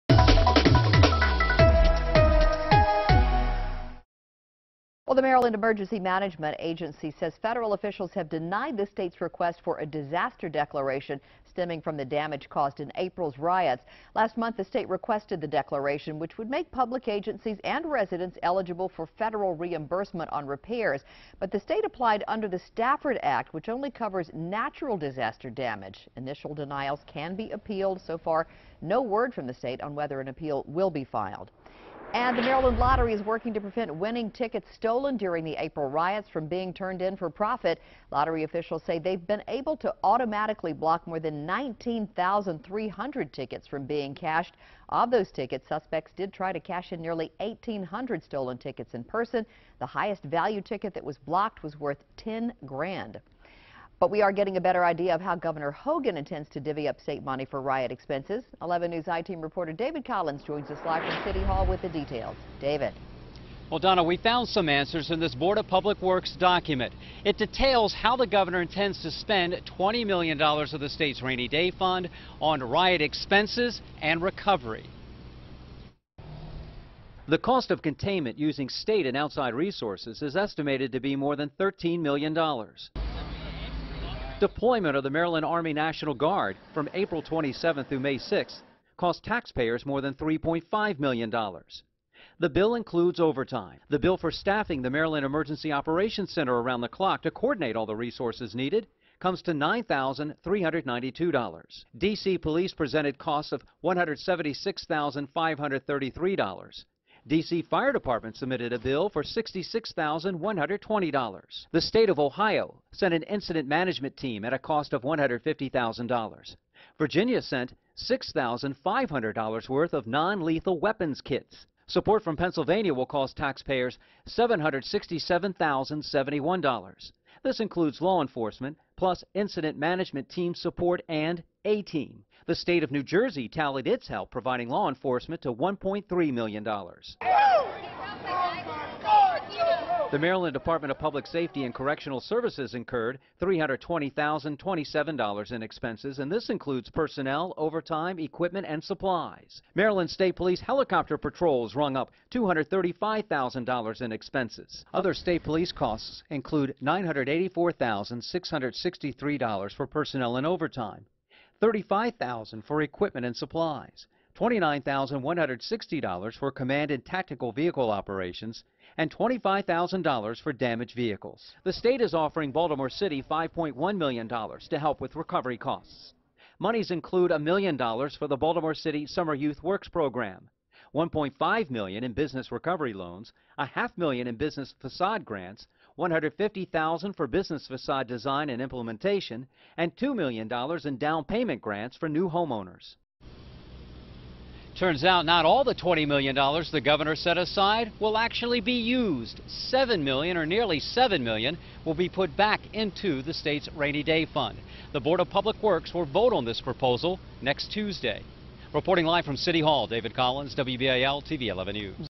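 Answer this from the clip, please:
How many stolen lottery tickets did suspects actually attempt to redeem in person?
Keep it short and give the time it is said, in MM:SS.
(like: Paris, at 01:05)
1,800, at 00:47.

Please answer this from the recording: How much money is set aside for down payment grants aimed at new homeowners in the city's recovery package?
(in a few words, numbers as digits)
$2 million.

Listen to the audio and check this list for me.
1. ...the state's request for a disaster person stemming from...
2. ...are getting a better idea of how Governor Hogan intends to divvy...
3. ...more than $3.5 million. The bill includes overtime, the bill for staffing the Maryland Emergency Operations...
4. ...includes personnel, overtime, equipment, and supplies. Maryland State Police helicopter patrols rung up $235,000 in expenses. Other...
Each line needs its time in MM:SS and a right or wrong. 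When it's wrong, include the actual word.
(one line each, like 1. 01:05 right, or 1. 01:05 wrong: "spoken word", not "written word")
1. 00:08 wrong: "declaration", not "person"
2. 00:54 right
3. 01:29 right
4. 02:26 right.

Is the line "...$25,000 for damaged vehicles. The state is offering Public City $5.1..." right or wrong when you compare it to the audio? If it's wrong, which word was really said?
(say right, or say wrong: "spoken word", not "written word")
wrong: "Baltimore", not "Public".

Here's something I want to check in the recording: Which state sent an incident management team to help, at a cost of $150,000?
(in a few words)
Ohio.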